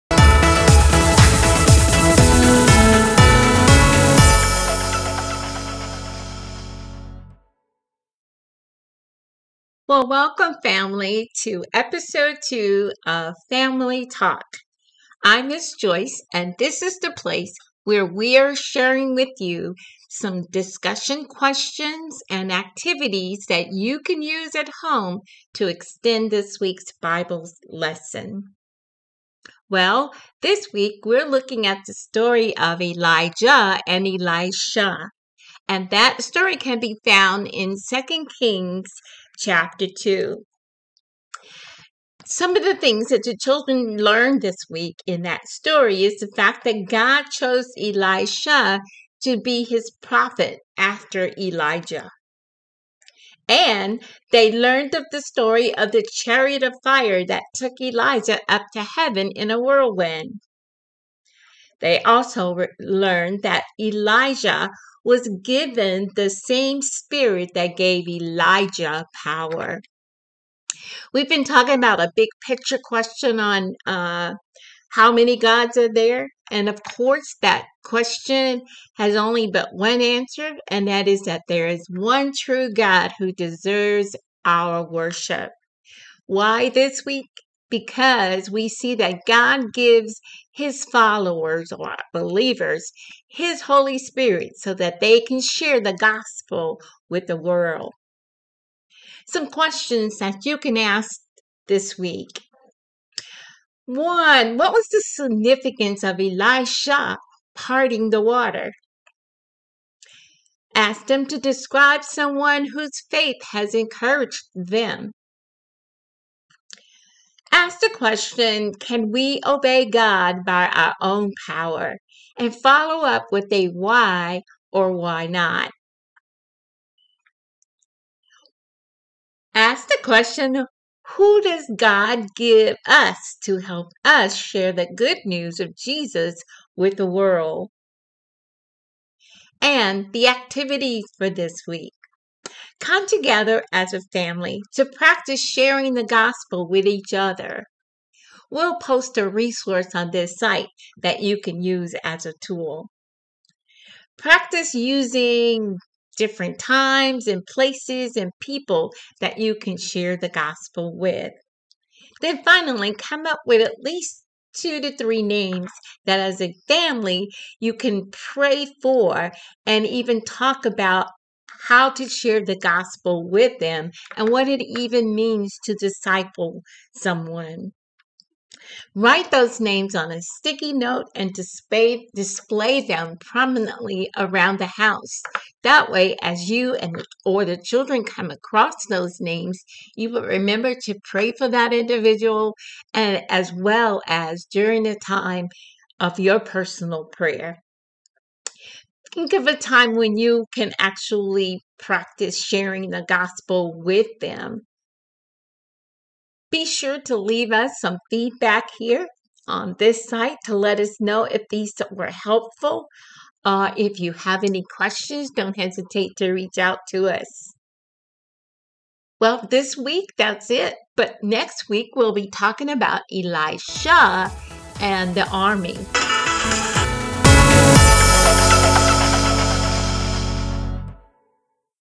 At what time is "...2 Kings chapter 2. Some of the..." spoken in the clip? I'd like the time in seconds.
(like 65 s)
37 s.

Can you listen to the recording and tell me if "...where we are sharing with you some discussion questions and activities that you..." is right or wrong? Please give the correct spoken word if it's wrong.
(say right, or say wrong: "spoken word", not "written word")
right.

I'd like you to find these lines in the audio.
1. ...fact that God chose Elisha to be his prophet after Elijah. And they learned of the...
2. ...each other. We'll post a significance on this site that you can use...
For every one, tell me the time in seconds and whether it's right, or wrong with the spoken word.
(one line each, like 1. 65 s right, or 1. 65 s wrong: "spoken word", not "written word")
1. 46 s right
2. 146 s wrong: "resource", not "significance".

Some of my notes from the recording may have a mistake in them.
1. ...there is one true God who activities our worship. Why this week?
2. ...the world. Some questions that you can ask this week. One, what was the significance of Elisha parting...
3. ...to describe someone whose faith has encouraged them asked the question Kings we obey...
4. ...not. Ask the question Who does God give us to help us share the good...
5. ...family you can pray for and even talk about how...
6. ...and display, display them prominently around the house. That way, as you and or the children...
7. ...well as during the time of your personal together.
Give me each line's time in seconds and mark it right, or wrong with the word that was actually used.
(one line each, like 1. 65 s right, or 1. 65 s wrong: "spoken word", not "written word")
1. 81 s wrong: "deserves", not "activities"
2. 97 s right
3. 111 s wrong: "Can", not "Kings"
4. 125 s right
5. 166 s right
6. 181 s right
7. 193 s wrong: "prayer", not "together".